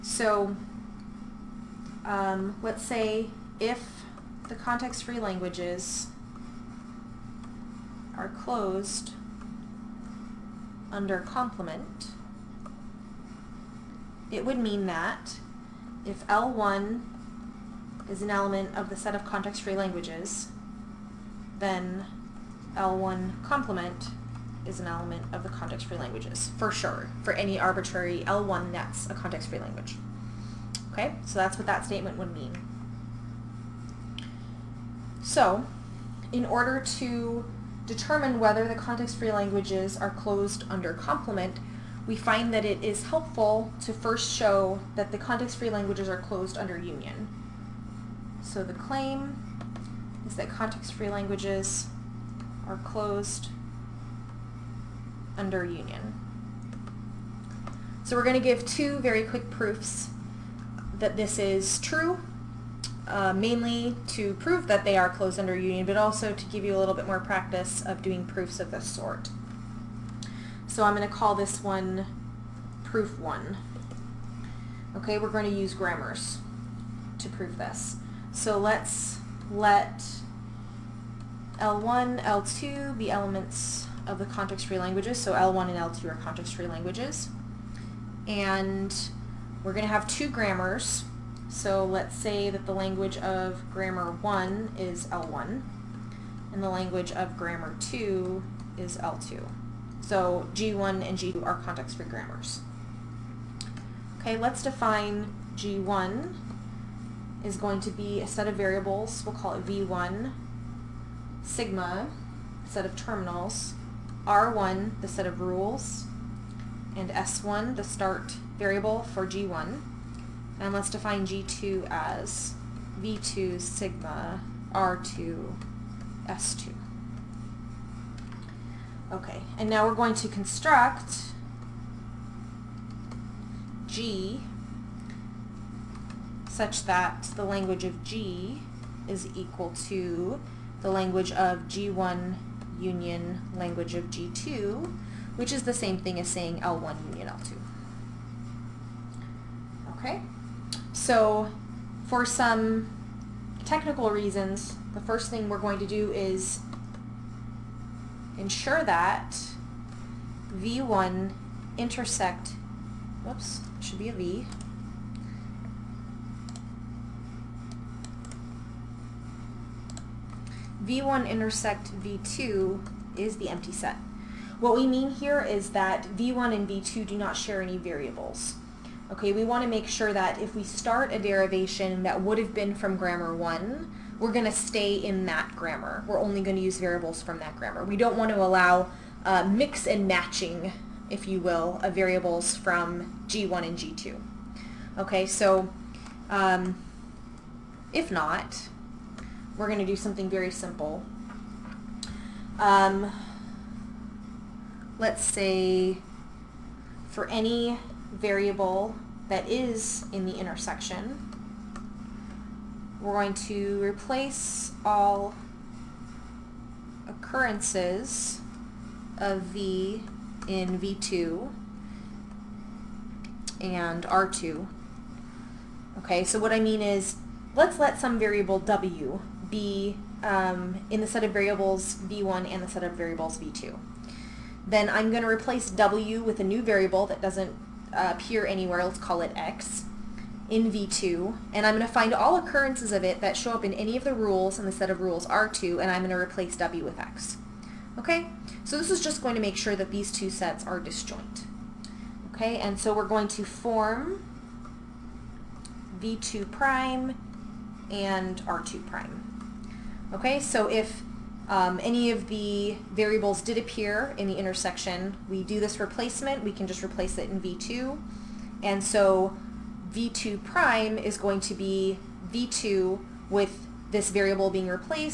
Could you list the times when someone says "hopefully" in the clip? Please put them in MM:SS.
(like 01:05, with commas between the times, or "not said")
not said.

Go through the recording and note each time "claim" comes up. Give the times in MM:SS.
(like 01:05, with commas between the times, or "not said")
00:48.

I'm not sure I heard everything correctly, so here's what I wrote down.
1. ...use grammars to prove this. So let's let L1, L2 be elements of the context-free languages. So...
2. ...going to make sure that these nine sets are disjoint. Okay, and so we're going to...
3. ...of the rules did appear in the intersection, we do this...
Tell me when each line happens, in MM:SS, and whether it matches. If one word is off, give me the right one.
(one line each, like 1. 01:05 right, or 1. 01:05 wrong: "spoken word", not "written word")
1. 01:15 right
2. 04:09 wrong: "two", not "nine"
3. 04:22 wrong: "variables", not "rules".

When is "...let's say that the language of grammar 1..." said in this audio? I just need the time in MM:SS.
01:31.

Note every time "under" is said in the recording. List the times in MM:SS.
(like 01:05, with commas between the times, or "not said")
00:10, 00:40, 00:46, 00:55, 01:05.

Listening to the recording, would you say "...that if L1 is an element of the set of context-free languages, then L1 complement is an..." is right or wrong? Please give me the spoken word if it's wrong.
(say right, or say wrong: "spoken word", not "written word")
right.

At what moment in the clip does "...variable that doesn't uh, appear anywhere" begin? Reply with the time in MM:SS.
03:56.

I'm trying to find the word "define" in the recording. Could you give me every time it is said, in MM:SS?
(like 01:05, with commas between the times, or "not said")
01:44, 02:00.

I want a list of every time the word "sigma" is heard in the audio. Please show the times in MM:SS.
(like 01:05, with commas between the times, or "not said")
01:51, 02:03.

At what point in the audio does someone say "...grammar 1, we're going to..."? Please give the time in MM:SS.
03:02.